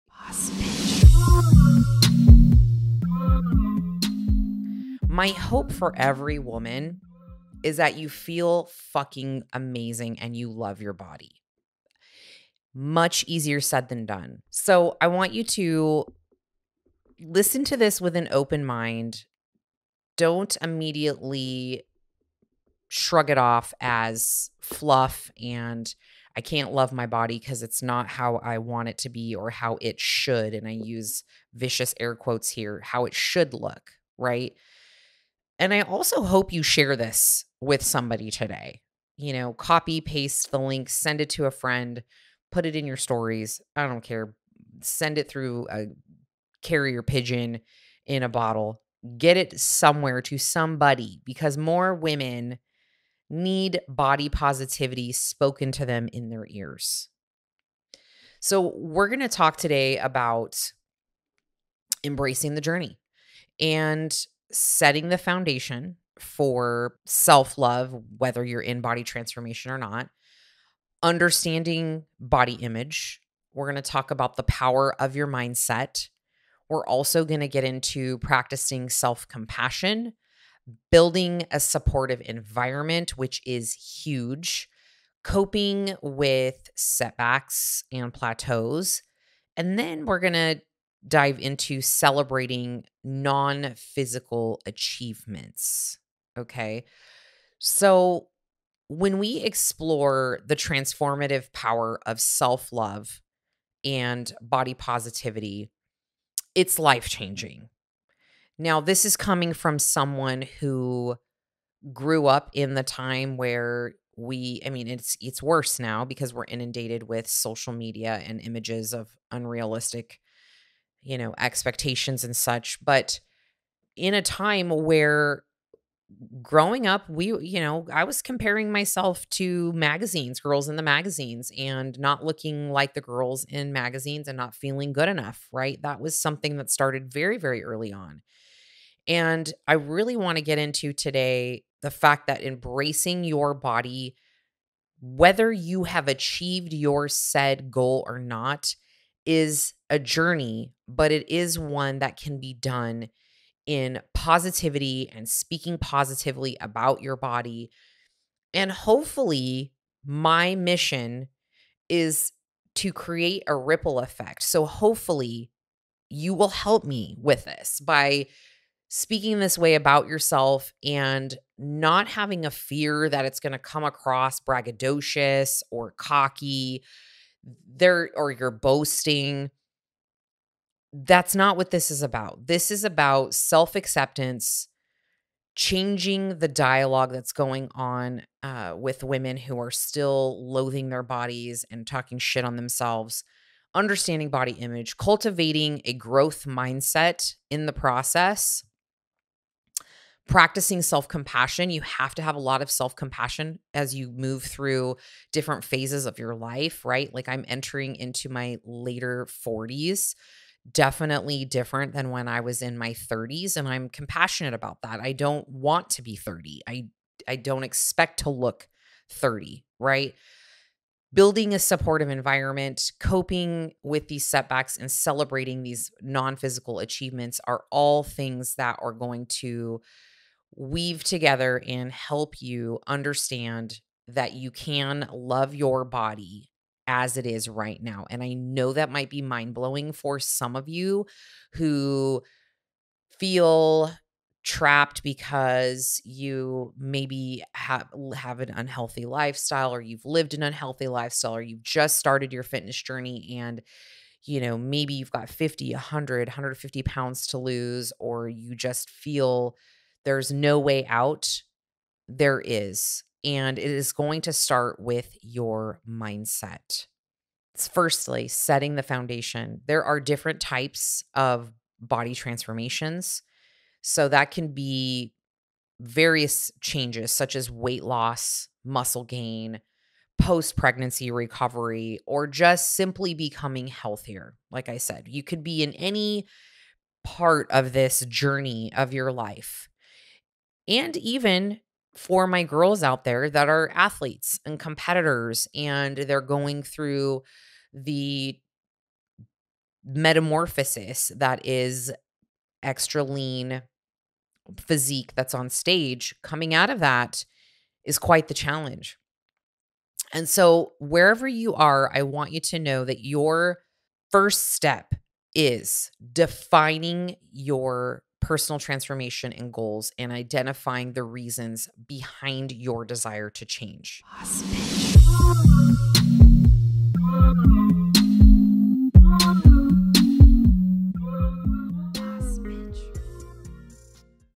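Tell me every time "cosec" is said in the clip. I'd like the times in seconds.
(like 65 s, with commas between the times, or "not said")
not said.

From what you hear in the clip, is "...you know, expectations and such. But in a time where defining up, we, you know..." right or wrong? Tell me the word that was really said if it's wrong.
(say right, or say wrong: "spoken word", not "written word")
wrong: "growing", not "defining".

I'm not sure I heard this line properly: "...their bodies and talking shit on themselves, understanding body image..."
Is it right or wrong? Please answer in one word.
right.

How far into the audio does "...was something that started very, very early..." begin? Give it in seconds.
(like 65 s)
135 s.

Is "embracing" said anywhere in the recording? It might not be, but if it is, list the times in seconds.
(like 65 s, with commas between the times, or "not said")
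62 s, 142 s.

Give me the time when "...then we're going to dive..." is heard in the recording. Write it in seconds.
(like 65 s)
89 s.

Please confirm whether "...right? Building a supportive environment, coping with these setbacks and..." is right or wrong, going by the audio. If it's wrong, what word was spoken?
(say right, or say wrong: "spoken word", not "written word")
right.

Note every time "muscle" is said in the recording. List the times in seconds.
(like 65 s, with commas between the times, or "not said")
278 s.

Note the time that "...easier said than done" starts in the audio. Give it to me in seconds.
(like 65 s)
13 s.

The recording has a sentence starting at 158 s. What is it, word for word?
And hopefully, my mission is to create a ripple effect.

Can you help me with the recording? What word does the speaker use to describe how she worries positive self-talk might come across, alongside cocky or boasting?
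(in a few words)
braggadocious.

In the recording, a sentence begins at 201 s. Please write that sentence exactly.
You have to have a lot of self compassion as you move through different phases of your life, right?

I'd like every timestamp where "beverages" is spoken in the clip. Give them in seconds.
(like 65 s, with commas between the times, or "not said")
not said.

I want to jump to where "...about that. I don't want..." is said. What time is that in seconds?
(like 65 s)
214 s.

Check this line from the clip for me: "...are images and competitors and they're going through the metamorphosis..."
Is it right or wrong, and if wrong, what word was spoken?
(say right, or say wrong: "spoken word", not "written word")
wrong: "athletes", not "images".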